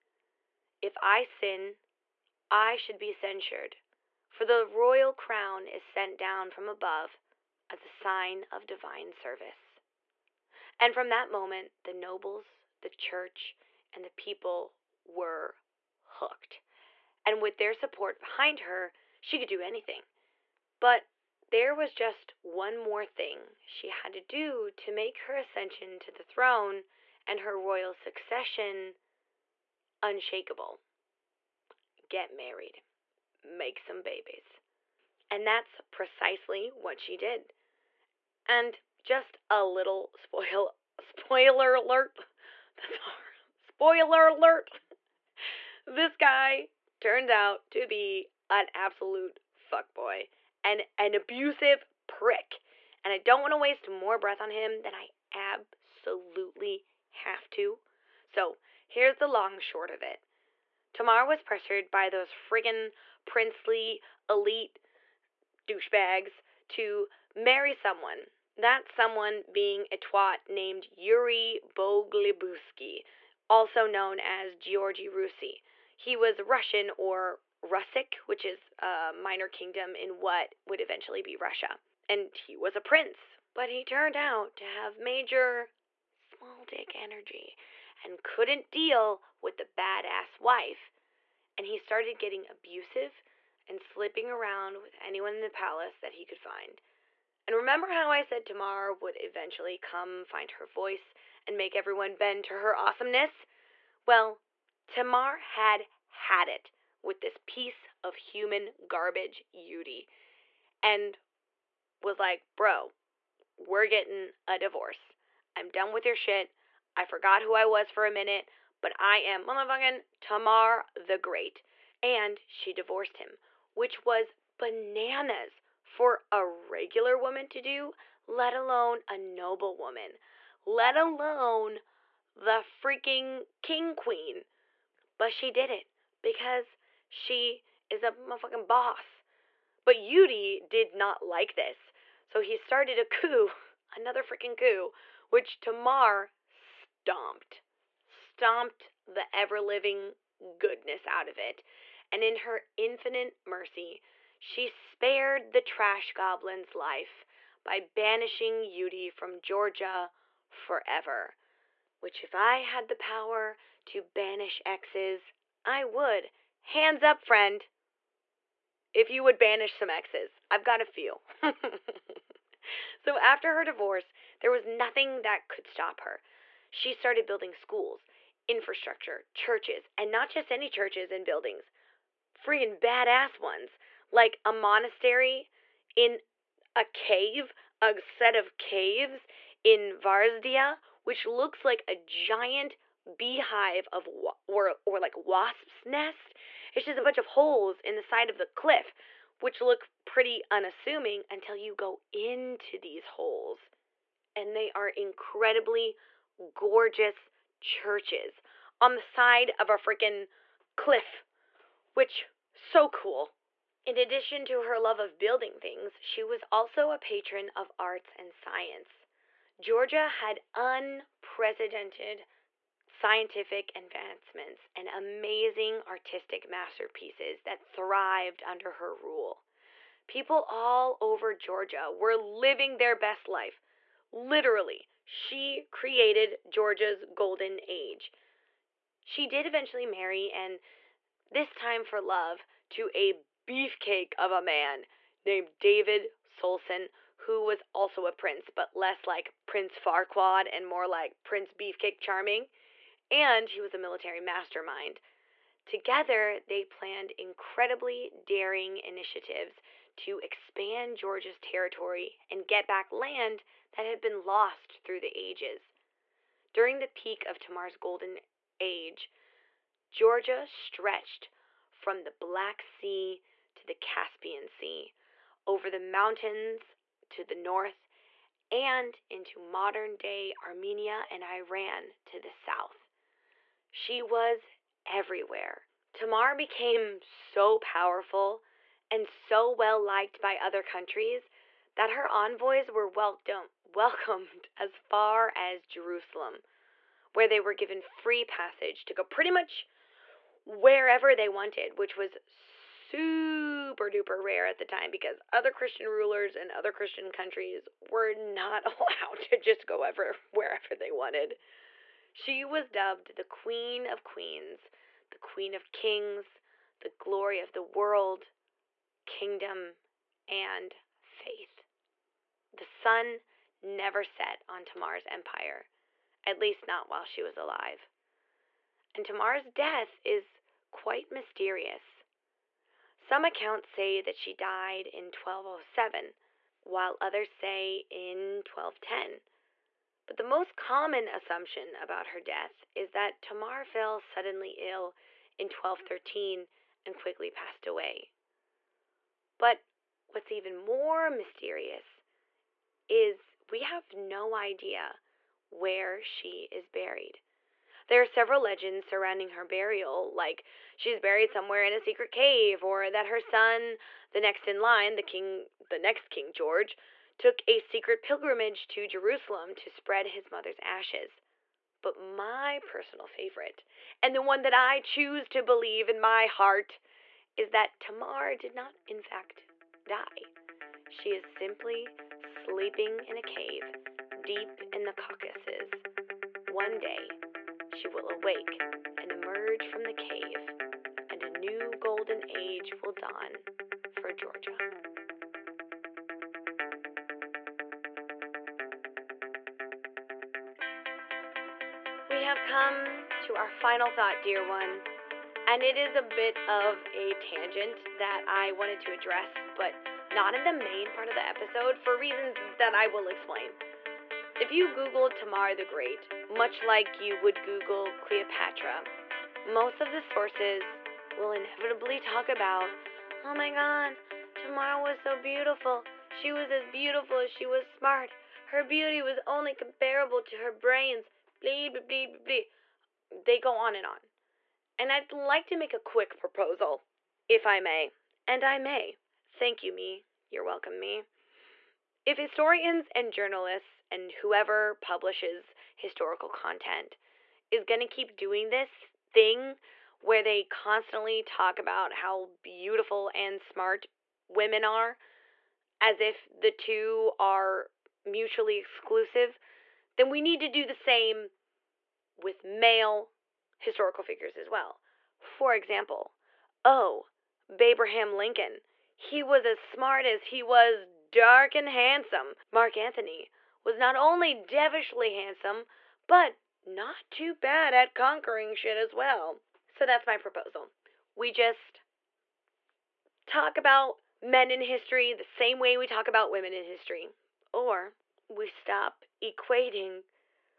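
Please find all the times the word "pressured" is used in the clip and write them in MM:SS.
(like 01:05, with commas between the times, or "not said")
01:01.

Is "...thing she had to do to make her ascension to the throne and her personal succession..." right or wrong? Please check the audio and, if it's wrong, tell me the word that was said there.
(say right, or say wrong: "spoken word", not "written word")
wrong: "royal", not "personal".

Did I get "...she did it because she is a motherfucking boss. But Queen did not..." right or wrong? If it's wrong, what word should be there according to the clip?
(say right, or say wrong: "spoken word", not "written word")
wrong: "Yudi", not "Queen".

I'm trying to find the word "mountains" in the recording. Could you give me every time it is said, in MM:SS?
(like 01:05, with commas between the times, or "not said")
04:35.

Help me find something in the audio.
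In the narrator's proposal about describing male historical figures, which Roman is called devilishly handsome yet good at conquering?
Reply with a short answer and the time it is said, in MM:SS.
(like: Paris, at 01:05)
Mark Anthony, at 07:52.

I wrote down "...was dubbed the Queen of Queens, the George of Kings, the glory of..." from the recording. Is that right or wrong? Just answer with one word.
wrong.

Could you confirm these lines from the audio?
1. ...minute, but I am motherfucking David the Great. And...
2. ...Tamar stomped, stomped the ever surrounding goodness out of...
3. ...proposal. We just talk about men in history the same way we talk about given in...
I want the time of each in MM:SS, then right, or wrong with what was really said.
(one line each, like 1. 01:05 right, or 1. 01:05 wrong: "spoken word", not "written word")
1. 01:58 wrong: "Tamar", not "David"
2. 02:25 wrong: "living", not "surrounding"
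3. 08:00 wrong: "women", not "given".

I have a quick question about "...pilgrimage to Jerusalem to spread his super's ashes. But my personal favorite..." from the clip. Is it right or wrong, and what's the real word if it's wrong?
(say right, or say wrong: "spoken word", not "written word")
wrong: "mother", not "super".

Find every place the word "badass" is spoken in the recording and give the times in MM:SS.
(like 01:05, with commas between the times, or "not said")
01:29, 03:02.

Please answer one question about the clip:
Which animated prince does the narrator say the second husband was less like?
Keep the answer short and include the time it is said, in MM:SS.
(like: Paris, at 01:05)
Prince Farquaad, at 04:09.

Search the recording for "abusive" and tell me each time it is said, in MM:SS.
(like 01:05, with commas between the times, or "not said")
00:51, 01:32.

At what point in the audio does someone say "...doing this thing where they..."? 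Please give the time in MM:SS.
07:28.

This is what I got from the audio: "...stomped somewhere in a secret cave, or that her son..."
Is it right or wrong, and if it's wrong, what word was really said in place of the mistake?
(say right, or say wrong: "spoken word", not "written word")
wrong: "buried", not "stomped".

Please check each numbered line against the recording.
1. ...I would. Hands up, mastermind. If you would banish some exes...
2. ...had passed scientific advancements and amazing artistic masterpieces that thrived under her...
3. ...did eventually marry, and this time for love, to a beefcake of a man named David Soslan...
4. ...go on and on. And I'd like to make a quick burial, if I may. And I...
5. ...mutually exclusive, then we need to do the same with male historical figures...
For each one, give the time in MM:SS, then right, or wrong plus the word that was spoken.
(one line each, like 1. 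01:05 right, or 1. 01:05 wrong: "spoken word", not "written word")
1. 02:45 wrong: "friend", not "mastermind"
2. 03:40 wrong: "unprecedented", not "passed"
3. 03:59 right
4. 07:13 wrong: "proposal", not "burial"
5. 07:38 right.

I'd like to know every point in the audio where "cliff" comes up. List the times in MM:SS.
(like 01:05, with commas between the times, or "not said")
03:18, 03:30.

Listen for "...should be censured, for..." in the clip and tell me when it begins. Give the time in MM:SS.
00:02.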